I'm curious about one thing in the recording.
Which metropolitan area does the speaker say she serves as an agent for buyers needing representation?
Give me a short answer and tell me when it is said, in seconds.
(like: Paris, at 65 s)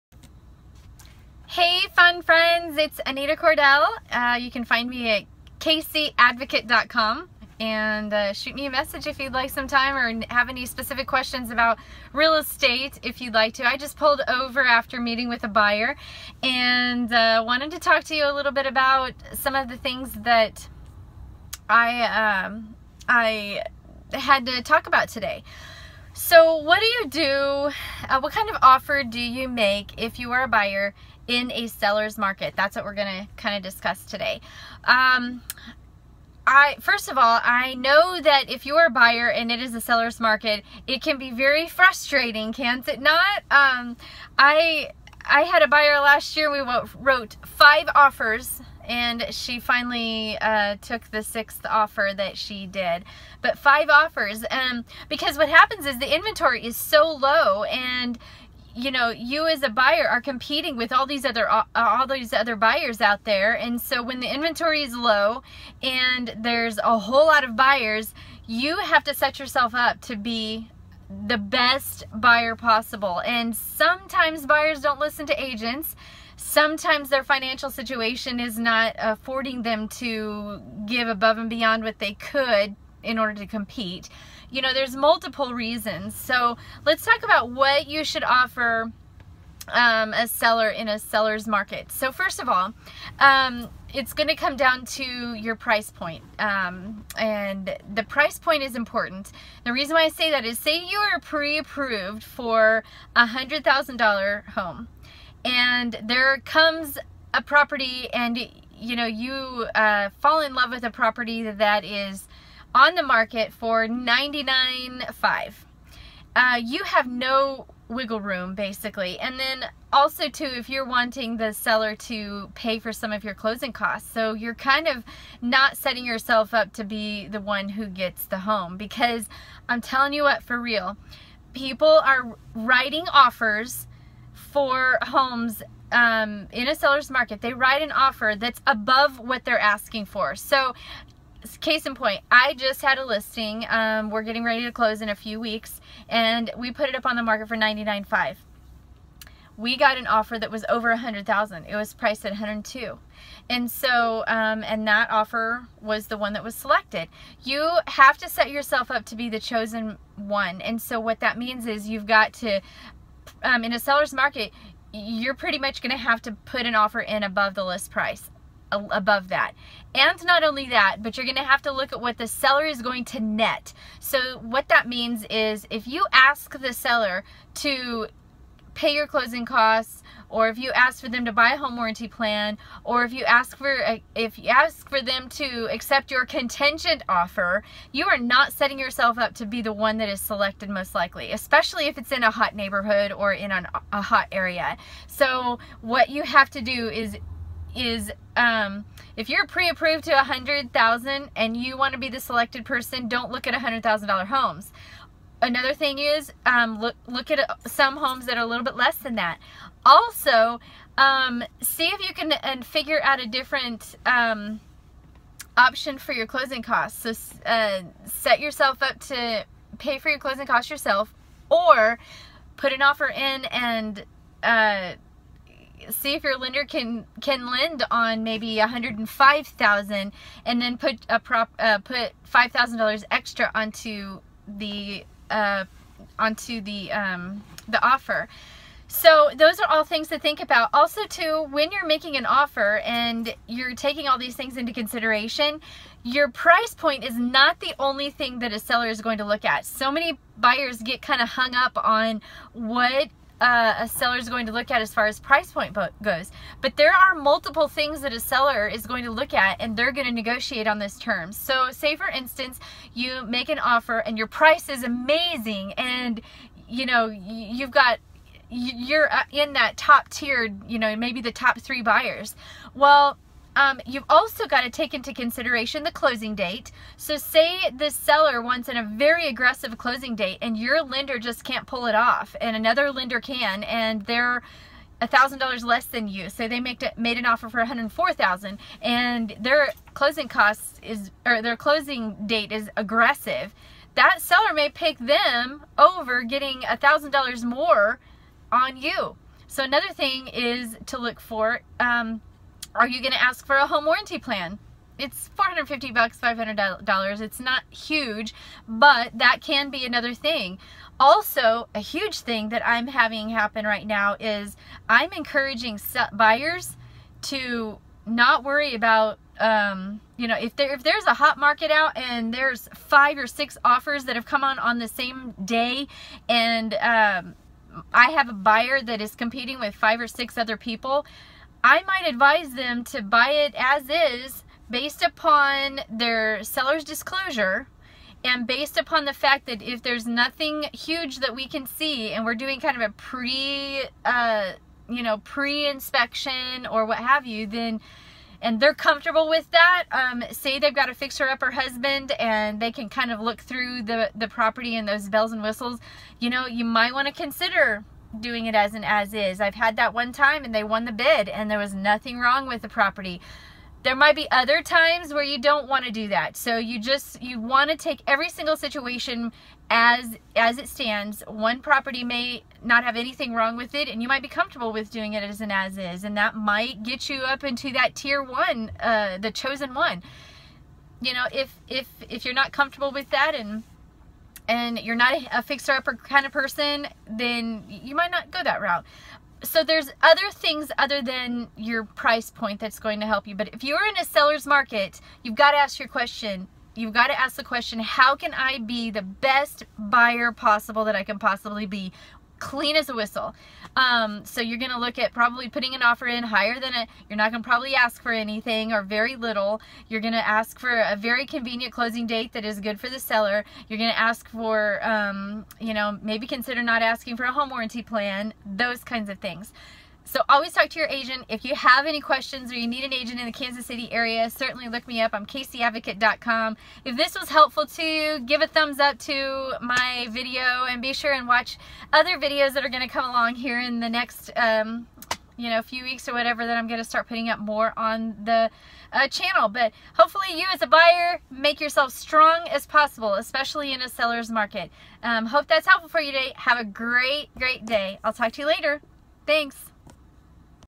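Kansas City, at 423 s.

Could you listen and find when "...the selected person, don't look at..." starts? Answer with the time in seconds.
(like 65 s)
202 s.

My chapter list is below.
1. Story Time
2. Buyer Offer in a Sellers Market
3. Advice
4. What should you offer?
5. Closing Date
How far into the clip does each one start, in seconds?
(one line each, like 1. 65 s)
1. 40 s
2. 30 s
3. 310 s
4. 88 s
5. 279 s.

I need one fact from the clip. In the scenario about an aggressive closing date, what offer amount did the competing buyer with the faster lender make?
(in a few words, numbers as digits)
104,000.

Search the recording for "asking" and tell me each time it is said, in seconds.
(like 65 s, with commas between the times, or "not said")
139 s, 416 s.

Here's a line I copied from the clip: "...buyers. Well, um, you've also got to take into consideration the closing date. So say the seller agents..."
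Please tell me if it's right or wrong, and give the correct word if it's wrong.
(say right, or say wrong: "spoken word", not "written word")
wrong: "wants", not "agents".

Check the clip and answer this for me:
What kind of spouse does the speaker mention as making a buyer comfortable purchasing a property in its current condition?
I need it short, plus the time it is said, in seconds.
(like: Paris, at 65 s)
fixer-upper husband, at 350 s.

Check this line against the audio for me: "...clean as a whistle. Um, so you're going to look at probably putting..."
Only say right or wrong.
right.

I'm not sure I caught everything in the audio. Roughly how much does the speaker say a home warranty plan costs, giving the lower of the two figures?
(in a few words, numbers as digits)
$450.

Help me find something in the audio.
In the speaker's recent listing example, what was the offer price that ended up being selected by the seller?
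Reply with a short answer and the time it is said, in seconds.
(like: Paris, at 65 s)
102, at 152 s.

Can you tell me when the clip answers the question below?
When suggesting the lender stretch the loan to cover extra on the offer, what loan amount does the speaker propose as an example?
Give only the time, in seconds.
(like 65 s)
228 s.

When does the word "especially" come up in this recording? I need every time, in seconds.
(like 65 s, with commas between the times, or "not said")
191 s, 443 s.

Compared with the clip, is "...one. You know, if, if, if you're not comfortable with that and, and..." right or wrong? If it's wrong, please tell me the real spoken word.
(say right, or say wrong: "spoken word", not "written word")
right.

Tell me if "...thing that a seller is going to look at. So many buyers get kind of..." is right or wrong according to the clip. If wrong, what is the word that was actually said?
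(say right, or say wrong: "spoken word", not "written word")
right.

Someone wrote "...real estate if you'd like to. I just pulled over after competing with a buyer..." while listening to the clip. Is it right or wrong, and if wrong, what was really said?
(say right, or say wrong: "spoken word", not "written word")
wrong: "meeting", not "competing".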